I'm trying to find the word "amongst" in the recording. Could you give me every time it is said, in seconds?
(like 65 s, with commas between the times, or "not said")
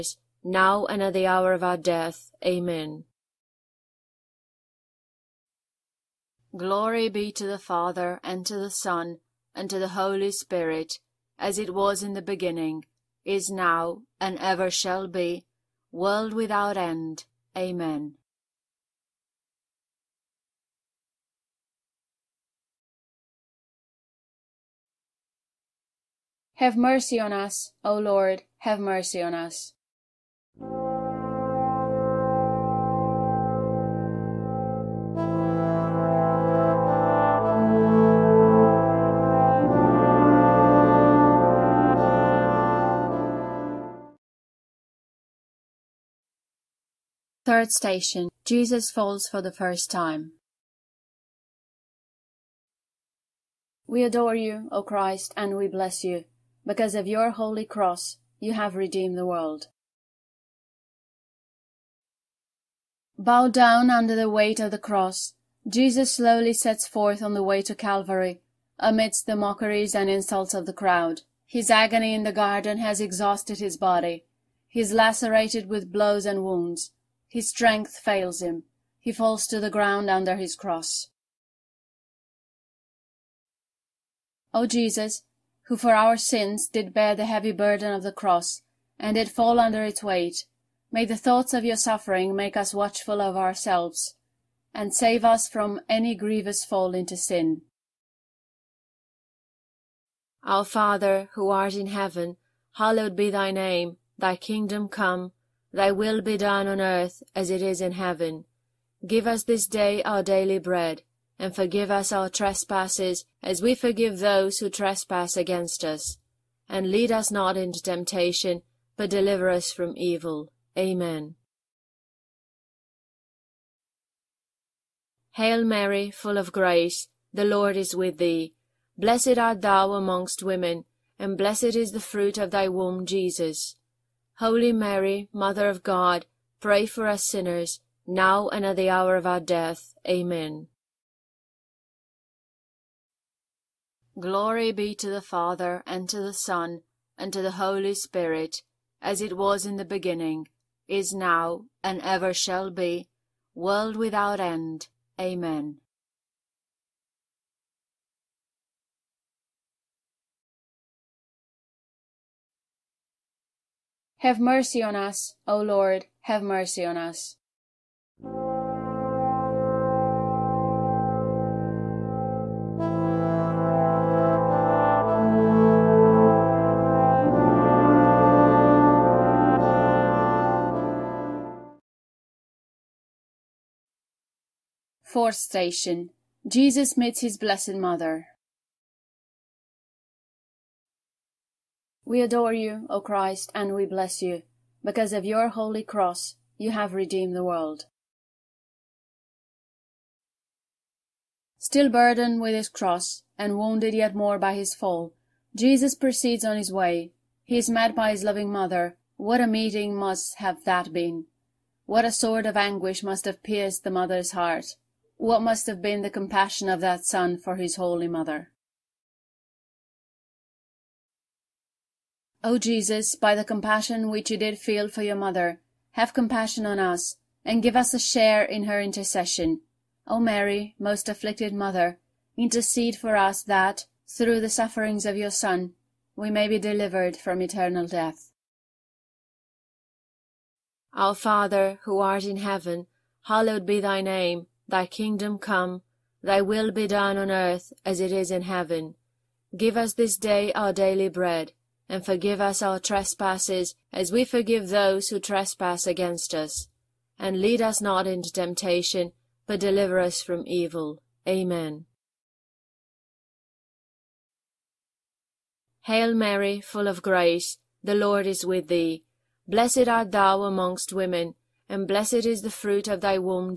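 129 s, 270 s.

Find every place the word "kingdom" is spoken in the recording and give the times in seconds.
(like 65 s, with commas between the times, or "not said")
104 s, 244 s.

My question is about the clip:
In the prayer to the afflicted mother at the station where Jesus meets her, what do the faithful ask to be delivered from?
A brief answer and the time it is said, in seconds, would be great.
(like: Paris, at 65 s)
Eternal death, at 237 s.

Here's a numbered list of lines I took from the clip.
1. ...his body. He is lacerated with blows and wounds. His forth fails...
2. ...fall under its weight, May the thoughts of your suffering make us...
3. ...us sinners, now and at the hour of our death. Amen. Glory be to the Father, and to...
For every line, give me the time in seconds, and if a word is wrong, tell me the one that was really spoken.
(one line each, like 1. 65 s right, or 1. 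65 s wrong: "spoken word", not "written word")
1. 73 s wrong: "strength", not "forth"
2. 89 s right
3. 137 s right.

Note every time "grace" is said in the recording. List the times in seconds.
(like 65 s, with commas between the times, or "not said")
126 s, 267 s.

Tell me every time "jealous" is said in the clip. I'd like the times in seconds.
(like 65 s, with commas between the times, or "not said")
not said.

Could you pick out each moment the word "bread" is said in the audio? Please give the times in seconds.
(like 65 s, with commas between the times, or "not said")
110 s, 251 s.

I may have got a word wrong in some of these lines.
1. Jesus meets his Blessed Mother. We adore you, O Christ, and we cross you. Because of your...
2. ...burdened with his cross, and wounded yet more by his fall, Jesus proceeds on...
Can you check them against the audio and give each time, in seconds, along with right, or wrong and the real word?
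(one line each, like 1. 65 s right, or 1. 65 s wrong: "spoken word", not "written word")
1. 186 s wrong: "bless", not "cross"
2. 201 s right.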